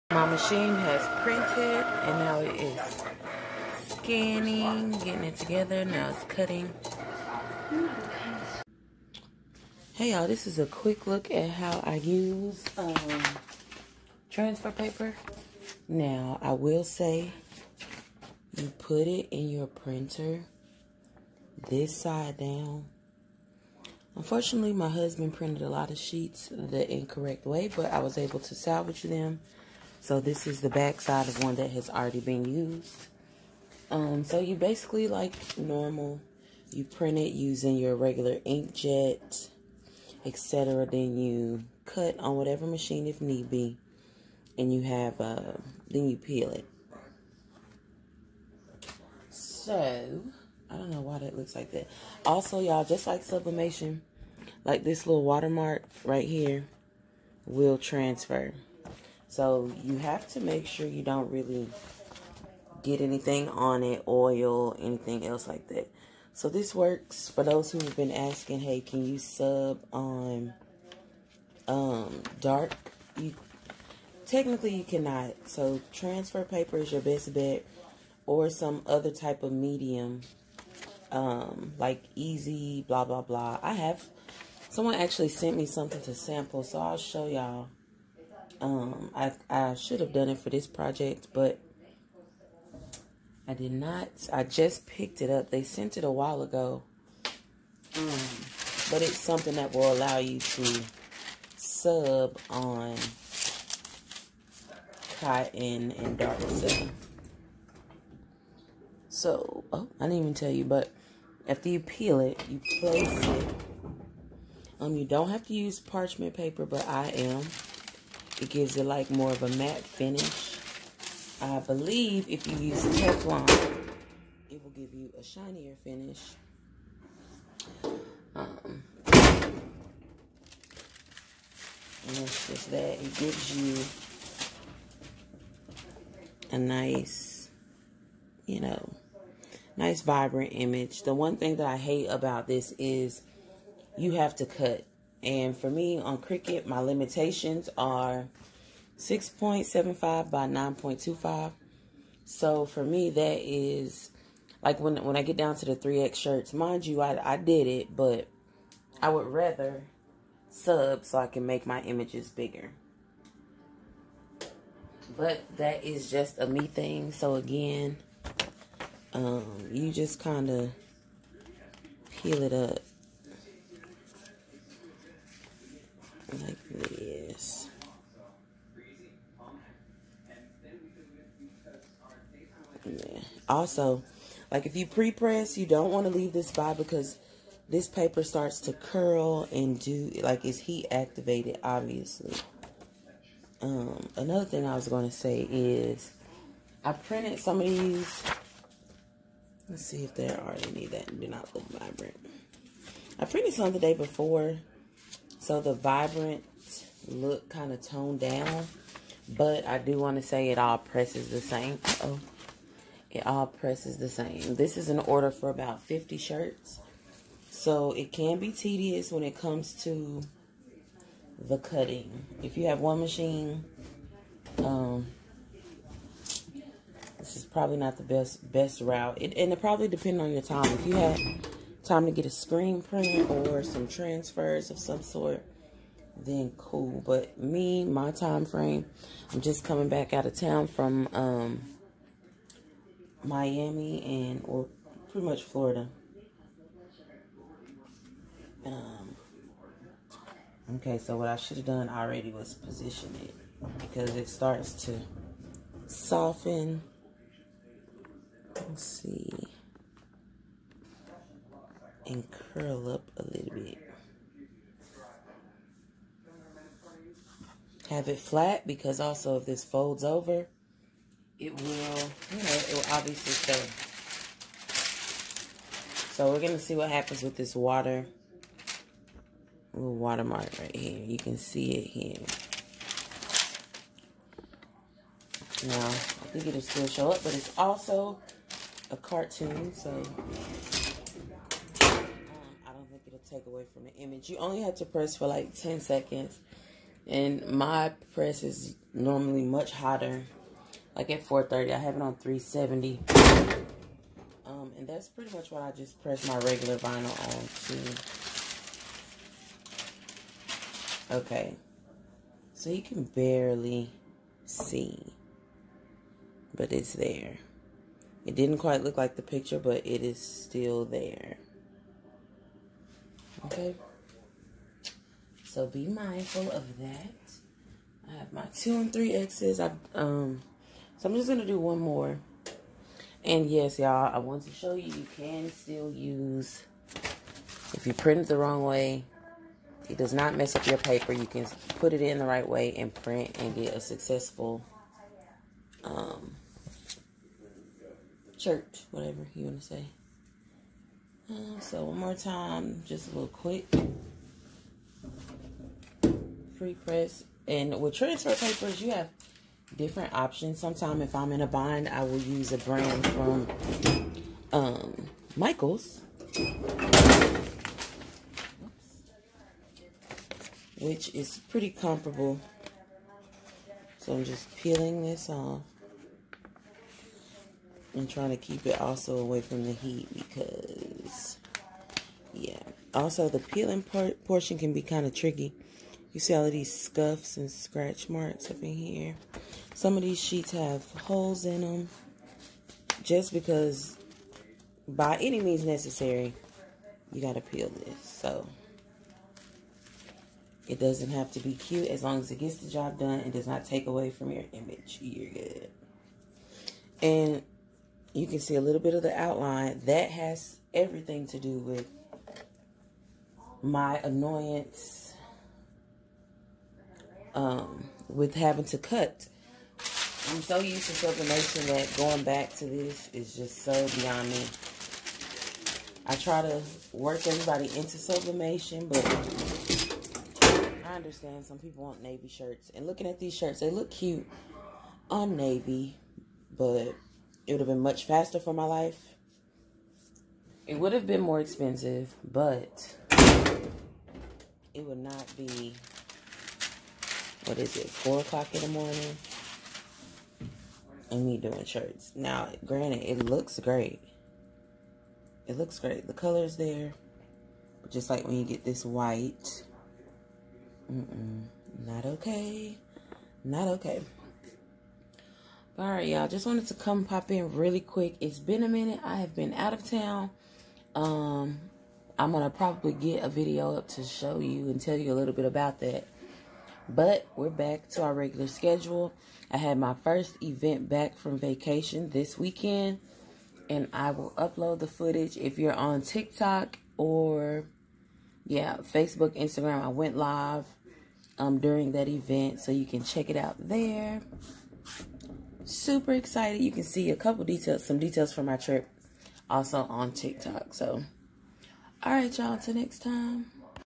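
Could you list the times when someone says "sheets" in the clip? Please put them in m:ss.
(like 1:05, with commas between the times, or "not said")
0:25, 6:30.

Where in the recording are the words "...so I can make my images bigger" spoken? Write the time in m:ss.
2:41.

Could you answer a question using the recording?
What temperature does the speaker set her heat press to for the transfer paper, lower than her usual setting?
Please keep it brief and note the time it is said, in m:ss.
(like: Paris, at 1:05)
370, at 5:02.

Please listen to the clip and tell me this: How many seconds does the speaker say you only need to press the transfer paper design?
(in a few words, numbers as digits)
10.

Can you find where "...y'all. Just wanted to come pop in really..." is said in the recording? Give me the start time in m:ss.
7:46.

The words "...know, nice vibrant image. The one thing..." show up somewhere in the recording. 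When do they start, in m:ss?
2:18.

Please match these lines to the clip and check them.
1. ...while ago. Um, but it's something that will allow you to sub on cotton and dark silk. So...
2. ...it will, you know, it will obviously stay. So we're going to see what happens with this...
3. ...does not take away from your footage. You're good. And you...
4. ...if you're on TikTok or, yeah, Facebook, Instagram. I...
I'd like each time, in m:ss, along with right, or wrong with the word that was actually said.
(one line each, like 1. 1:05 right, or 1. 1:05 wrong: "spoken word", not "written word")
1. 1:36 right
2. 4:31 right
3. 6:43 wrong: "image", not "footage"
4. 8:05 right.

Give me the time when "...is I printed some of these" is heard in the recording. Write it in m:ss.
3:15.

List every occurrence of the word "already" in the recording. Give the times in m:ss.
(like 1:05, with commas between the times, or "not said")
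0:31, 4:11.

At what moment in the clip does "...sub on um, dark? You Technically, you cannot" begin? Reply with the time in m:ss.
1:09.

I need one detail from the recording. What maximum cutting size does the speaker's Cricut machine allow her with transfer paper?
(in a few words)
6.75 by 9.25.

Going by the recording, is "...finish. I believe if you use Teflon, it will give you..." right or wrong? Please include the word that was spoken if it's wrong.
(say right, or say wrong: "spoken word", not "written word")
right.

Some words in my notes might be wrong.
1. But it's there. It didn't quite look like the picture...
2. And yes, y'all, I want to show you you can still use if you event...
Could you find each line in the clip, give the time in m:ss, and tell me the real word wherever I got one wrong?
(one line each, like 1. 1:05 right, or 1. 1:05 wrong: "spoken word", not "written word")
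1. 5:16 right
2. 5:33 wrong: "print", not "event".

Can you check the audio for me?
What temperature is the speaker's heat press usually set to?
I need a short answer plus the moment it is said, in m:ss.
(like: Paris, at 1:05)
430, at 5:01.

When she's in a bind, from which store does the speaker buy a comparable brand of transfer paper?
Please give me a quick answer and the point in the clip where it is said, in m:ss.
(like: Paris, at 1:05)
Michaels, at 6:05.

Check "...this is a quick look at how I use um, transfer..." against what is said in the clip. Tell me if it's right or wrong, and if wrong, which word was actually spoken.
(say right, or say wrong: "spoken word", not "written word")
right.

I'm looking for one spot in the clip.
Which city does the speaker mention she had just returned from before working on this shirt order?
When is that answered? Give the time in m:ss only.
4:03.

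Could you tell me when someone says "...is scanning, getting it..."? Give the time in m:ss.
0:02.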